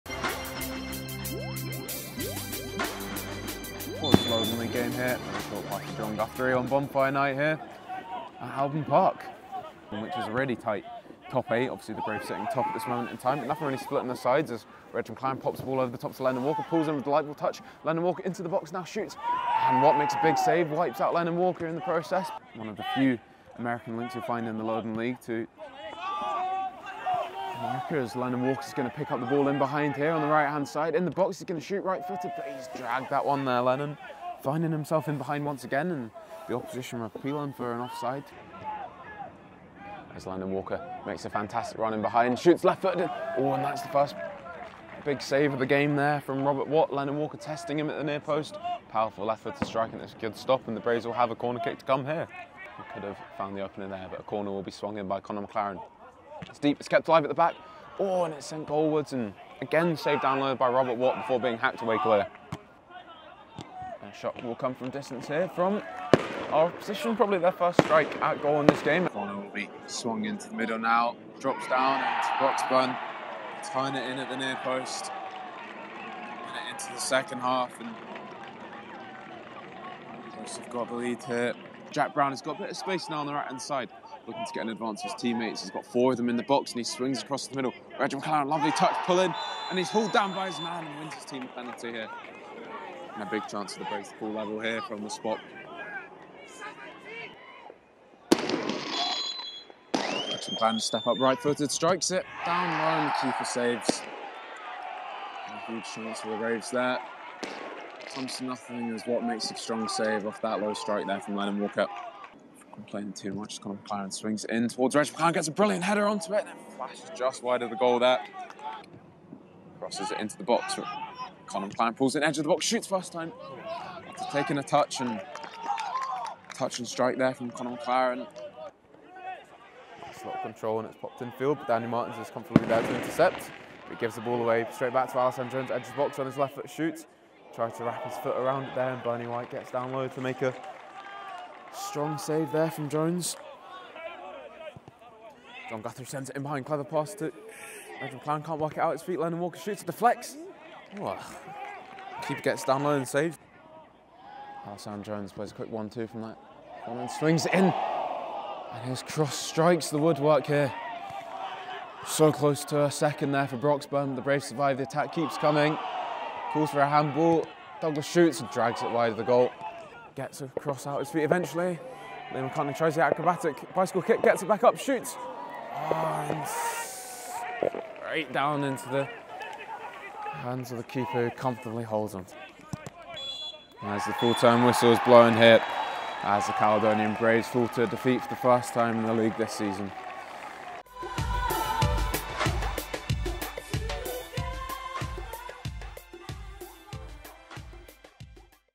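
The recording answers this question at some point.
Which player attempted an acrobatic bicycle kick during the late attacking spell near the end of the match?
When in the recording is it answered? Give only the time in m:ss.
2:52.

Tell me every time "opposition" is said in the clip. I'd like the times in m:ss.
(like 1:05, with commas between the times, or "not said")
0:36.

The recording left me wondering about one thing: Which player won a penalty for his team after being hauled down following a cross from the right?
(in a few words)
Reggie McLaren.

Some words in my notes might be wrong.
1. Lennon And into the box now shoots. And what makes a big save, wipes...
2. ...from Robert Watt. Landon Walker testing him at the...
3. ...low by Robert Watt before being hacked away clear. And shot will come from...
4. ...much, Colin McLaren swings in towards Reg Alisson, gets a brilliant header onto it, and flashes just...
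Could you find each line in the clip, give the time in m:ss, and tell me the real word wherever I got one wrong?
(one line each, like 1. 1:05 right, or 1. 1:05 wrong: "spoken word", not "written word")
1. 0:17 wrong: "Walker", not "And"
2. 0:46 right
3. 1:00 right
4. 1:53 wrong: "McLaren", not "Alisson".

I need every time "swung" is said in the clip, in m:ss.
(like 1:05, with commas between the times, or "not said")
0:54, 1:09.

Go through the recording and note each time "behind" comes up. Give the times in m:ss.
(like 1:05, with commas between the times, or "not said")
0:29, 0:35, 0:42, 2:26.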